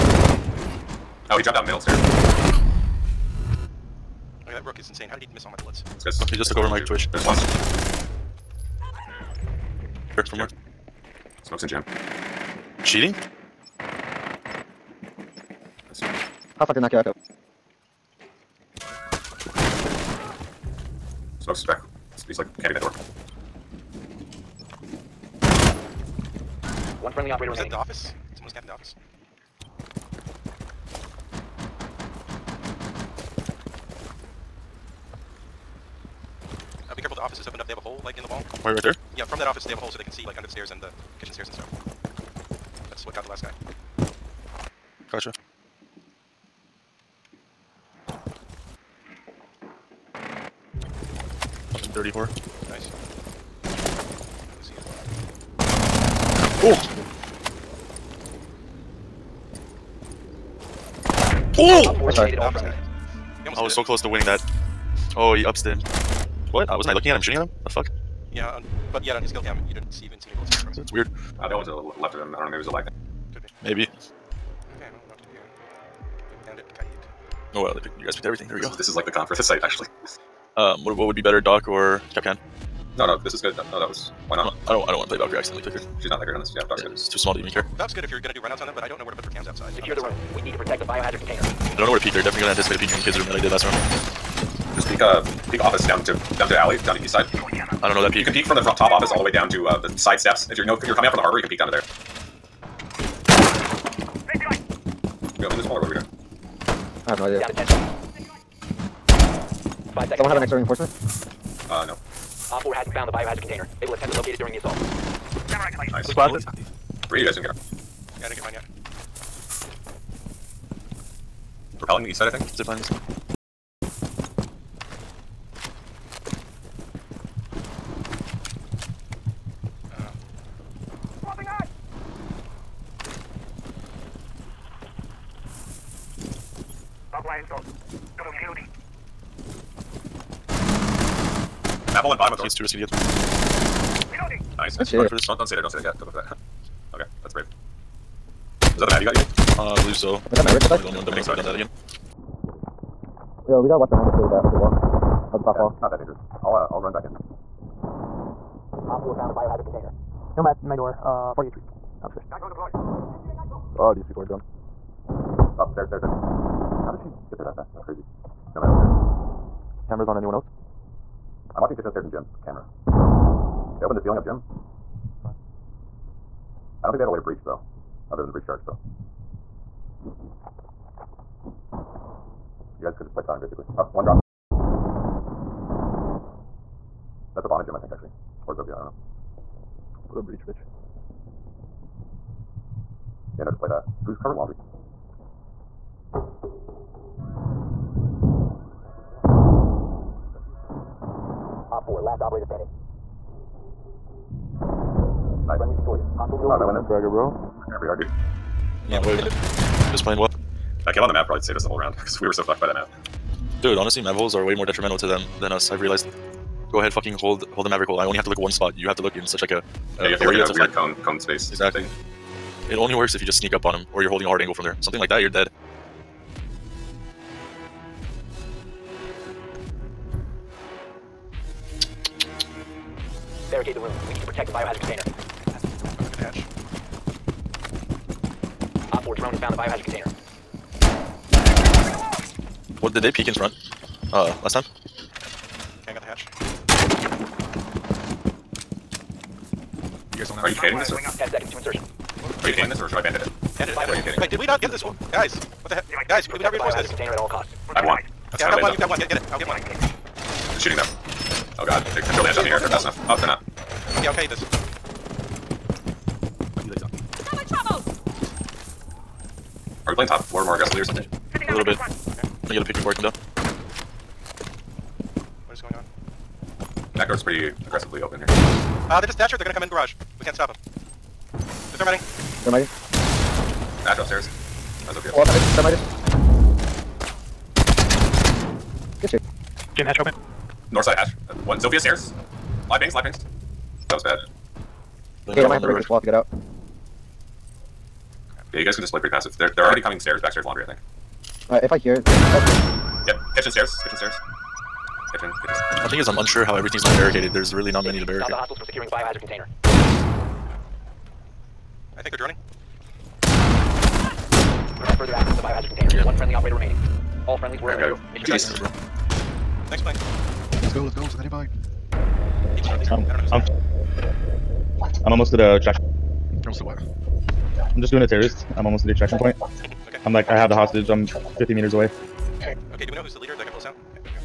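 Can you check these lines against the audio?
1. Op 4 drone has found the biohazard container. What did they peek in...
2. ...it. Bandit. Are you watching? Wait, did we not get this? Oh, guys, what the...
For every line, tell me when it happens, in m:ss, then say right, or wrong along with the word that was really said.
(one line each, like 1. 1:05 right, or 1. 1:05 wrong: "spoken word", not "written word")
1. 3:58 right
2. 4:13 wrong: "kidding", not "watching".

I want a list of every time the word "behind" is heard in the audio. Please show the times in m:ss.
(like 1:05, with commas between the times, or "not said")
2:33.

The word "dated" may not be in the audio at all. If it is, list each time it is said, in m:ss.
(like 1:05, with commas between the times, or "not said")
not said.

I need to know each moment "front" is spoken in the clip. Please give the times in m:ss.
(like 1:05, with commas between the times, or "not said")
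1:38, 4:03.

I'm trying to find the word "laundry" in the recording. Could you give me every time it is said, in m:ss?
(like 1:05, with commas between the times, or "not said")
3:14, 5:00.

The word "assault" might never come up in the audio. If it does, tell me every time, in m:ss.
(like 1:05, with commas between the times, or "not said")
1:54.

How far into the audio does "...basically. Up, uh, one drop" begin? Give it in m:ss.
3:03.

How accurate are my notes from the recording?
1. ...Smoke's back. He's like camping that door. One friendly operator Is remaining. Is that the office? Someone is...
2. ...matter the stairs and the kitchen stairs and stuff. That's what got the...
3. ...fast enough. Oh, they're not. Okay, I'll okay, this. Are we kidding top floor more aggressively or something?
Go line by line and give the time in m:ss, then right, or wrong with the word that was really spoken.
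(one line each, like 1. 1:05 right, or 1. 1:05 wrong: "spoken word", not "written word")
1. 0:21 right
2. 0:40 wrong: "under", not "matter"
3. 4:22 wrong: "playing", not "kidding".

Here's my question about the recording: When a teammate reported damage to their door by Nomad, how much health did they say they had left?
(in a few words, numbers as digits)
40 HP.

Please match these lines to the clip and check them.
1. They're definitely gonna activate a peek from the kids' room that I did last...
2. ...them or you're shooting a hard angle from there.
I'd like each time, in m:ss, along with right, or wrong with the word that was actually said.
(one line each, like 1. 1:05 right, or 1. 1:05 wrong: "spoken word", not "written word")
1. 1:32 wrong: "anticipate", not "activate"
2. 3:43 wrong: "holding", not "shooting".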